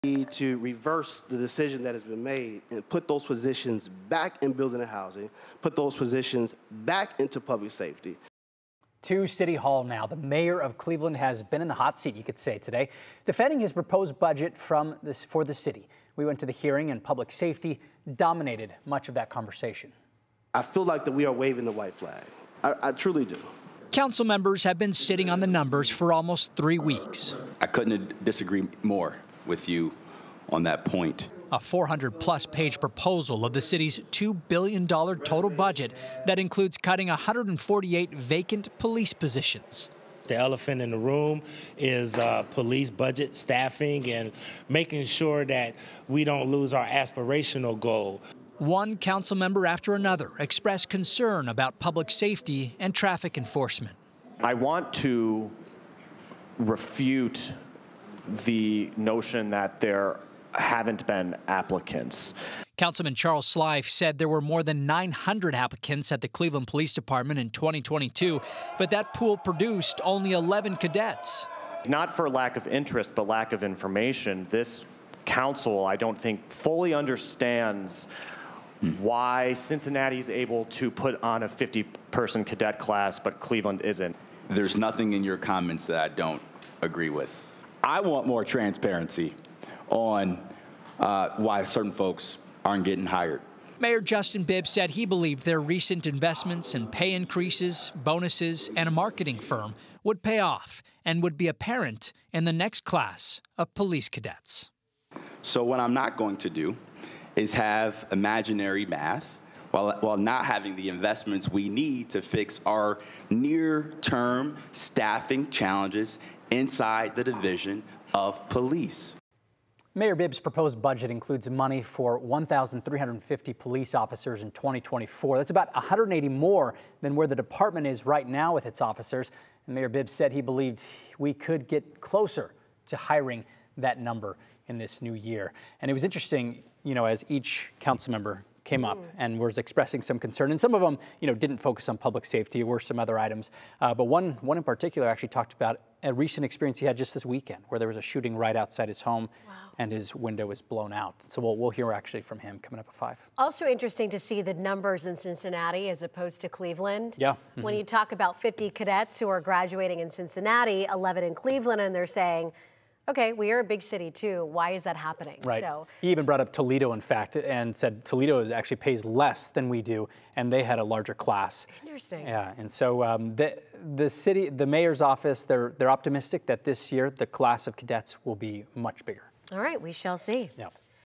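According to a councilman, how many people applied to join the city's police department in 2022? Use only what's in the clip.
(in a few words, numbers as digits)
more than 900.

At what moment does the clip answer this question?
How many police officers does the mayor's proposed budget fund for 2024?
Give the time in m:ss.
2:02.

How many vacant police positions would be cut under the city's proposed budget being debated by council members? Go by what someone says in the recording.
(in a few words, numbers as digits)
148.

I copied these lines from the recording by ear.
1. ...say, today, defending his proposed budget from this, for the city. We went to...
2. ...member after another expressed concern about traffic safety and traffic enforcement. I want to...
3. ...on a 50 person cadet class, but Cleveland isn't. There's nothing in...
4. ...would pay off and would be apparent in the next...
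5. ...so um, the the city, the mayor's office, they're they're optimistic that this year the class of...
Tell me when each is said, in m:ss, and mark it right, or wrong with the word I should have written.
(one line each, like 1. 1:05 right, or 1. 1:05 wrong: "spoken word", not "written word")
1. 0:12 right
2. 0:49 wrong: "public", not "traffic"
3. 1:21 right
4. 1:40 right
5. 2:52 right.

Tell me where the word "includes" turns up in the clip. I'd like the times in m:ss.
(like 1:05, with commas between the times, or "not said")
0:36, 2:01.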